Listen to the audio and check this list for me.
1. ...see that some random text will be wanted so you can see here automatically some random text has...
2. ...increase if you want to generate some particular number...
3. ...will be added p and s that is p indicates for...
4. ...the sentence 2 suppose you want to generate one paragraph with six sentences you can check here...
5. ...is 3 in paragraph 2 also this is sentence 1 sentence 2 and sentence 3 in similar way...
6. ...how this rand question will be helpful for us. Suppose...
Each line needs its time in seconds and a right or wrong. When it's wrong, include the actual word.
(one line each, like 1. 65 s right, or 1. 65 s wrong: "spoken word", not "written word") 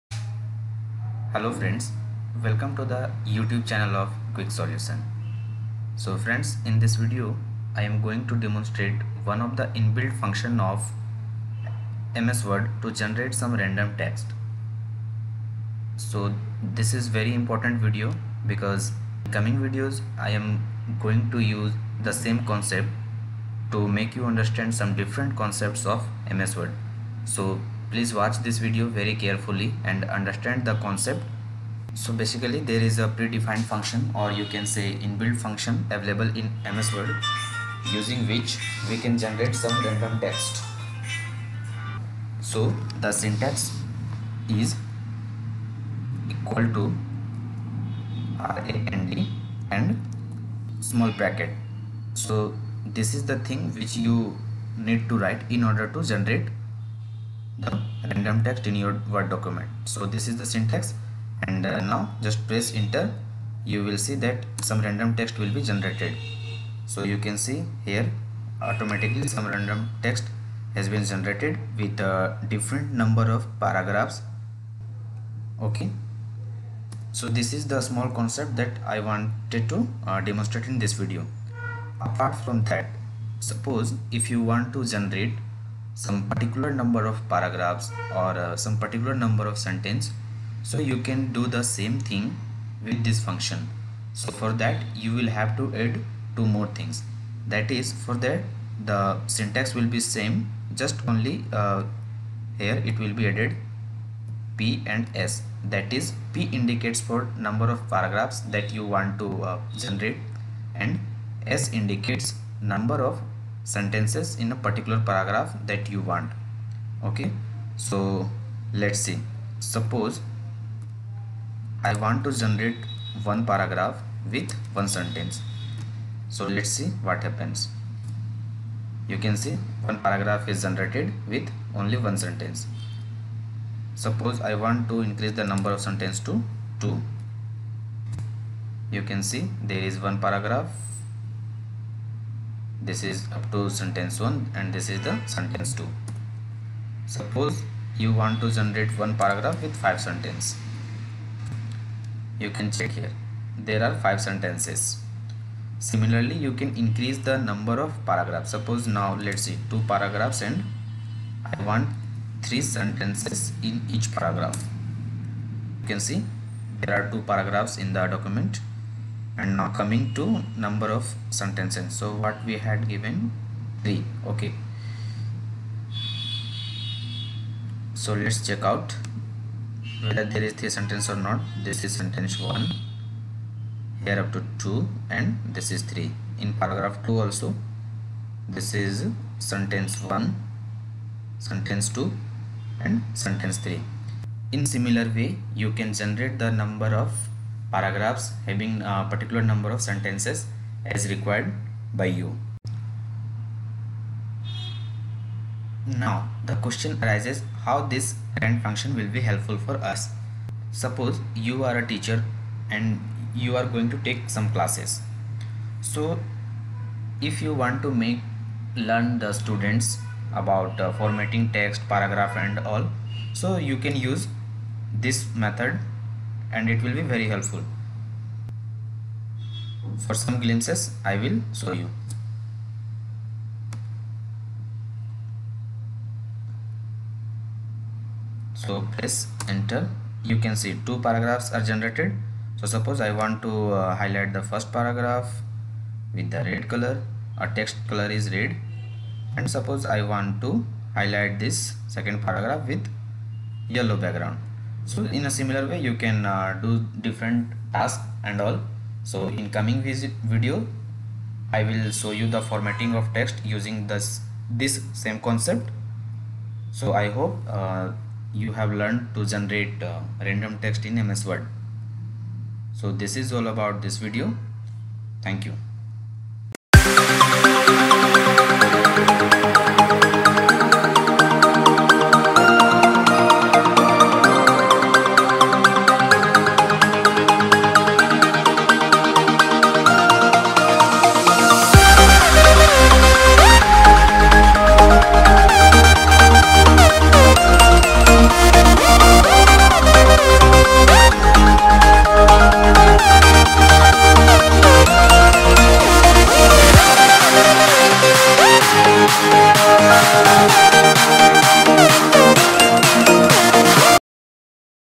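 1. 63 s wrong: "generated", not "wanted"
2. 83 s wrong: "suppose", not "increase"
3. 102 s right
4. 145 s wrong: "five", not "six"
5. 185 s right
6. 207 s wrong: "function", not "question".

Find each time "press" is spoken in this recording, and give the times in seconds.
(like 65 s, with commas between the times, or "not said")
62 s, 238 s.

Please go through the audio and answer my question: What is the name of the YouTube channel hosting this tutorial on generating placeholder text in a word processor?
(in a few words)
Quick Solution.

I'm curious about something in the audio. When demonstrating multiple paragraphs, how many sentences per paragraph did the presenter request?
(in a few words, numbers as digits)
3.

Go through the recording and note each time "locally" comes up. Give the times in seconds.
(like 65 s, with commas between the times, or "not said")
not said.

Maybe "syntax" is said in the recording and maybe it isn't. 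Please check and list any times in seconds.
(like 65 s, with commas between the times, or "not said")
43 s, 60 s, 99 s.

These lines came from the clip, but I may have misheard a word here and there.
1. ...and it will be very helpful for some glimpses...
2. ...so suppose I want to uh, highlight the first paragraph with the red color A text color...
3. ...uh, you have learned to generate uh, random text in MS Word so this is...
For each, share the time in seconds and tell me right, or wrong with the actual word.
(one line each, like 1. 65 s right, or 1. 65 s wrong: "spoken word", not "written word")
1. 226 s right
2. 242 s right
3. 267 s right.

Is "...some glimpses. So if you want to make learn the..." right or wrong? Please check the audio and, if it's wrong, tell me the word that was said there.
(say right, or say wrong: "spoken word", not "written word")
wrong: "classes", not "glimpses".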